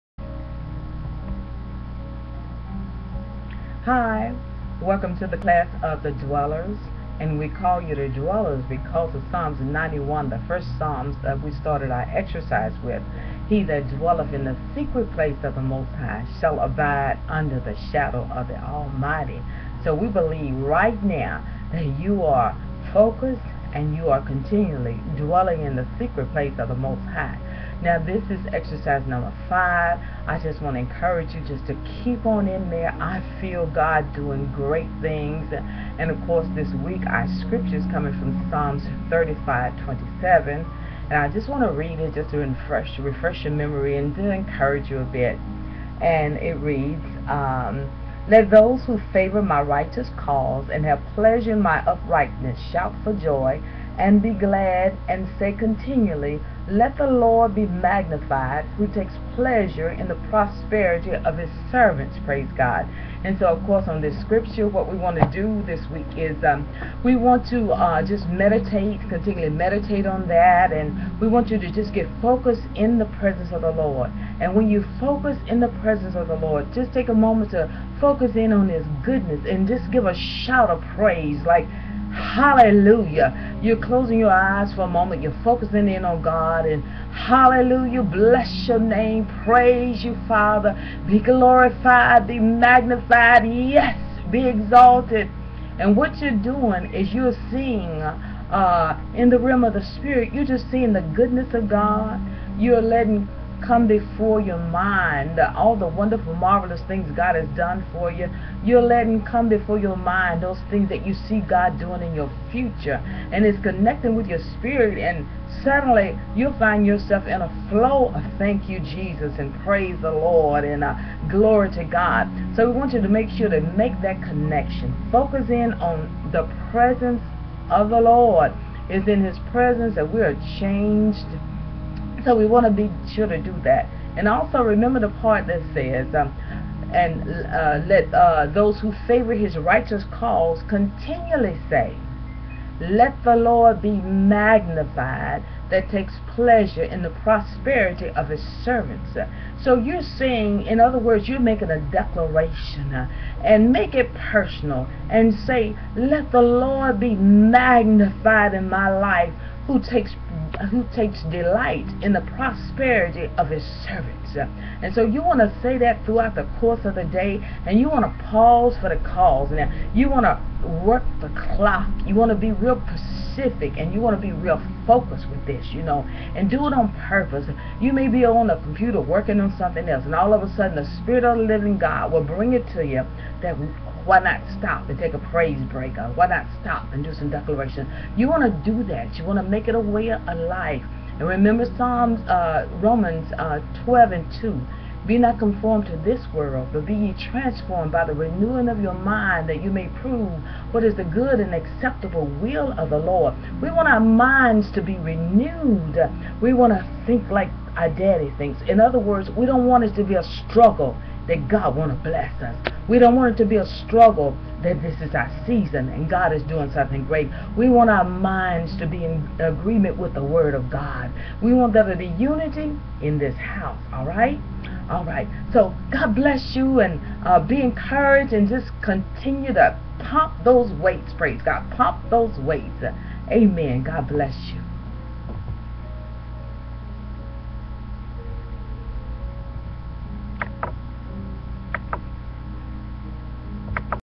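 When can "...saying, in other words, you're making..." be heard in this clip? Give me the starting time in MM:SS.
02:30.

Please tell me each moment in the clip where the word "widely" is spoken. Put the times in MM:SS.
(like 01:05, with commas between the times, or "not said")
not said.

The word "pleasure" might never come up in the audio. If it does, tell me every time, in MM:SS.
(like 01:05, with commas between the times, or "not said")
00:51, 00:59, 02:26.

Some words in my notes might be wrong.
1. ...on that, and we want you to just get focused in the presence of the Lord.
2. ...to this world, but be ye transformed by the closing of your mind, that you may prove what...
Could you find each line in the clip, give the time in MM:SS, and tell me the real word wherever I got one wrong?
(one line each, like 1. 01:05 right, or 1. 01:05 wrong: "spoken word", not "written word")
1. 01:10 right
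2. 03:15 wrong: "renewing", not "closing".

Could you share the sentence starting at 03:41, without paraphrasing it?
We want there to be unity in this house, all right?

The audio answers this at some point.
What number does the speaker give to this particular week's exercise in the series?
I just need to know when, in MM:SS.
00:28.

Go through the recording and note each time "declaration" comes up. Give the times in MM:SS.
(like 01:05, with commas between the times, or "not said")
02:31, 03:07.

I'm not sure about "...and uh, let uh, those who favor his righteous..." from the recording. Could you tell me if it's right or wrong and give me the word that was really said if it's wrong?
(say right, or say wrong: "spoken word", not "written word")
right.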